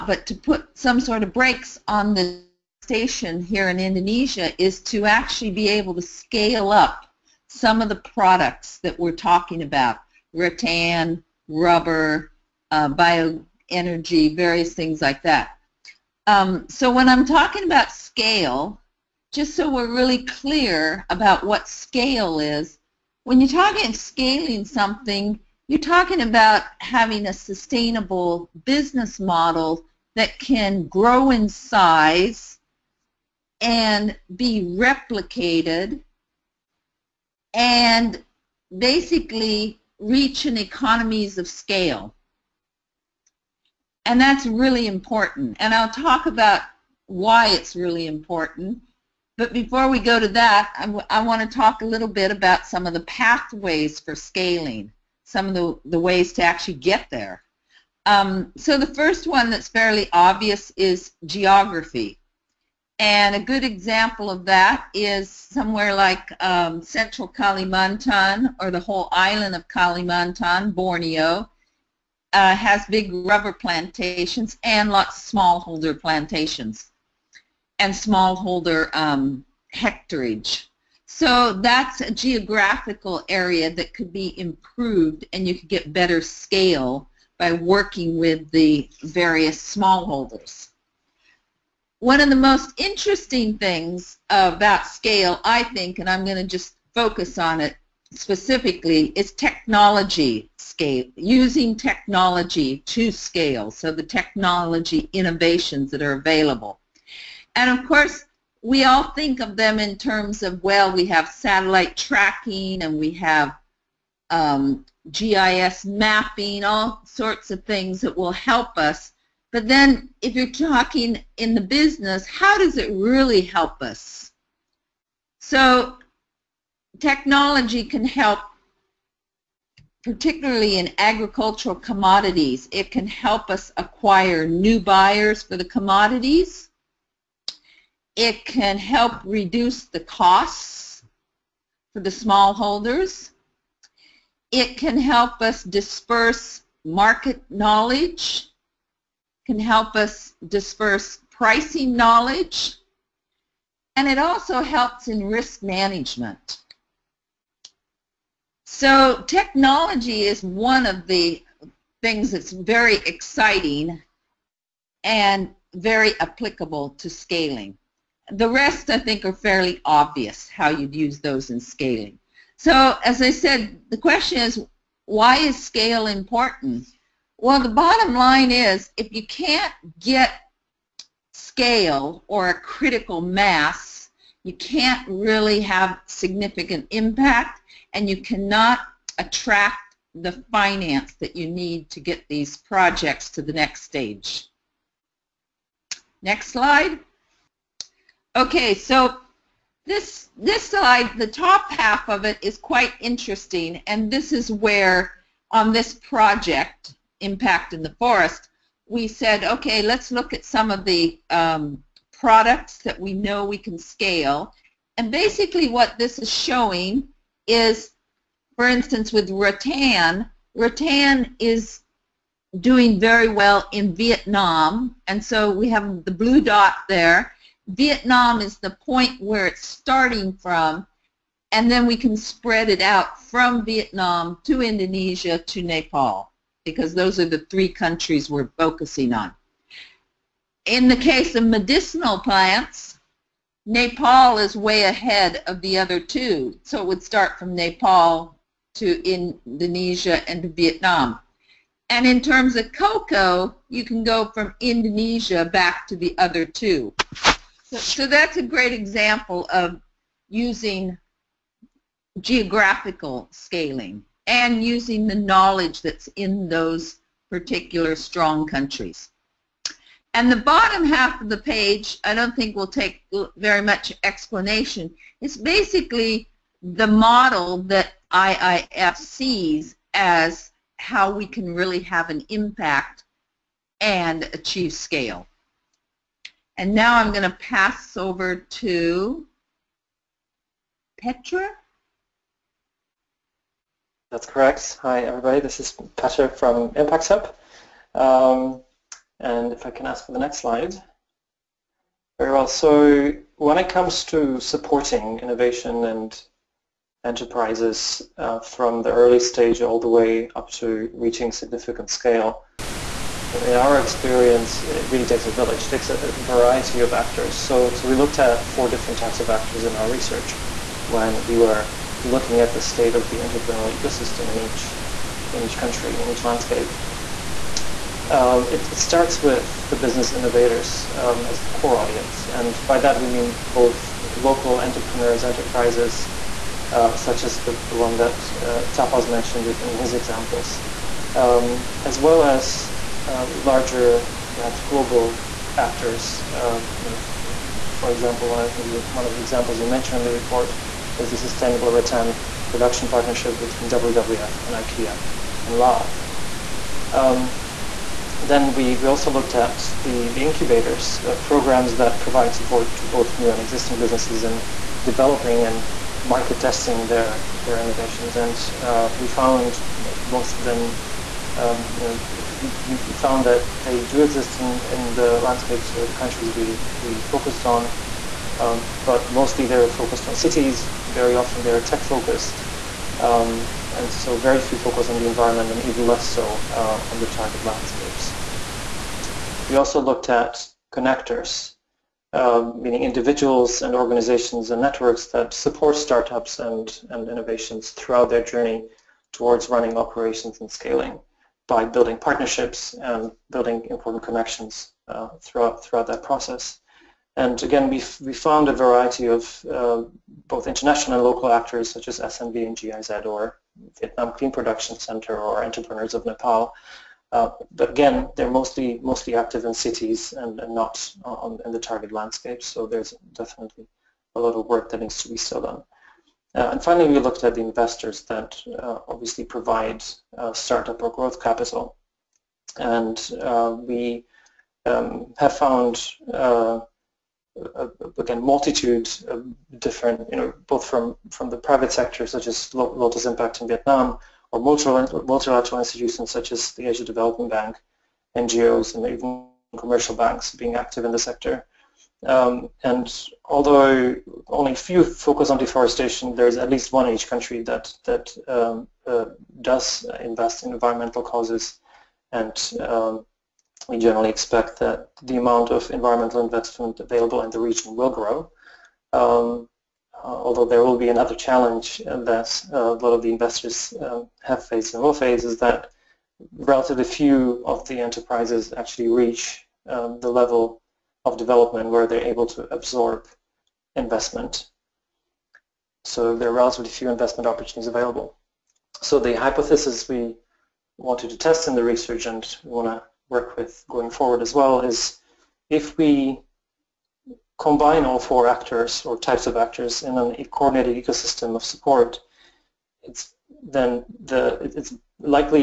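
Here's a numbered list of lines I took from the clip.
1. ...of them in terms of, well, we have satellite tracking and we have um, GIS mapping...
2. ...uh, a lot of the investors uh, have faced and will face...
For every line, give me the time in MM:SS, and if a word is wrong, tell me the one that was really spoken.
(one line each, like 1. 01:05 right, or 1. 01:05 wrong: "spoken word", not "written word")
1. 01:49 right
2. 07:52 right.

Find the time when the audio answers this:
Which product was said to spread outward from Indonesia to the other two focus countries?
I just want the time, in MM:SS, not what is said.
04:12.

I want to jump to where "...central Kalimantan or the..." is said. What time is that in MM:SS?
01:06.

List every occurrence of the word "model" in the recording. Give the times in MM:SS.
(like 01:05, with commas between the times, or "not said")
00:29, 04:36.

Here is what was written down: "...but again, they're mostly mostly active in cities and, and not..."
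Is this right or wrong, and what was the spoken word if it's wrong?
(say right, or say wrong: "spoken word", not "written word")
right.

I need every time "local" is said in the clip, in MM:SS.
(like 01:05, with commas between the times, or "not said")
05:34, 06:51.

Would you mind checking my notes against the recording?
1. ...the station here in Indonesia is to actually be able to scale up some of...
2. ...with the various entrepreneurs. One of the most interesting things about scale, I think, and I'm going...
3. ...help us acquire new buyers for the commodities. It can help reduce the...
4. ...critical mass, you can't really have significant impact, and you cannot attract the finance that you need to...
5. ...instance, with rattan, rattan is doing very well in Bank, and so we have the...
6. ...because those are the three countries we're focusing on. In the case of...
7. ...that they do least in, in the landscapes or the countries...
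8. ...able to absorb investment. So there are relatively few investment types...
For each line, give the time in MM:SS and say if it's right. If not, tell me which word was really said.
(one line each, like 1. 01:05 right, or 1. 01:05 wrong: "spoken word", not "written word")
1. 00:02 right
2. 01:28 wrong: "smallholders", not "entrepreneurs"
3. 02:13 right
4. 03:02 right
5. 03:38 wrong: "Vietnam", not "Bank"
6. 03:56 right
7. 06:13 wrong: "exist", not "least"
8. 08:02 wrong: "opportunities", not "types".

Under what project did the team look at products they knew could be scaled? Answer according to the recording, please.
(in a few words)
Impact in the Forest.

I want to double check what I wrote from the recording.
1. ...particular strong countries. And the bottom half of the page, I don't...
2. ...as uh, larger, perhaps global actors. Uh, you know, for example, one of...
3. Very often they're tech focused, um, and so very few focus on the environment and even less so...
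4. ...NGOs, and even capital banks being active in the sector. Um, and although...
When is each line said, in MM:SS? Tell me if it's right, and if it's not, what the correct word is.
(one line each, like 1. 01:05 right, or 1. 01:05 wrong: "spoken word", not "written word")
1. 04:27 right
2. 05:42 right
3. 06:20 right
4. 07:28 wrong: "commercial", not "capital".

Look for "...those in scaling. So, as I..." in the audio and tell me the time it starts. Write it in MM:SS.
02:51.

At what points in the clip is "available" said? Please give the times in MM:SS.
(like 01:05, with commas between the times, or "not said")
01:46, 07:46, 08:07.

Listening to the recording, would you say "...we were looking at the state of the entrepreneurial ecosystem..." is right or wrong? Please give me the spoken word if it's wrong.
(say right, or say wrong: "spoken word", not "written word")
right.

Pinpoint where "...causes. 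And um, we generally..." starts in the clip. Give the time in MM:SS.
07:41.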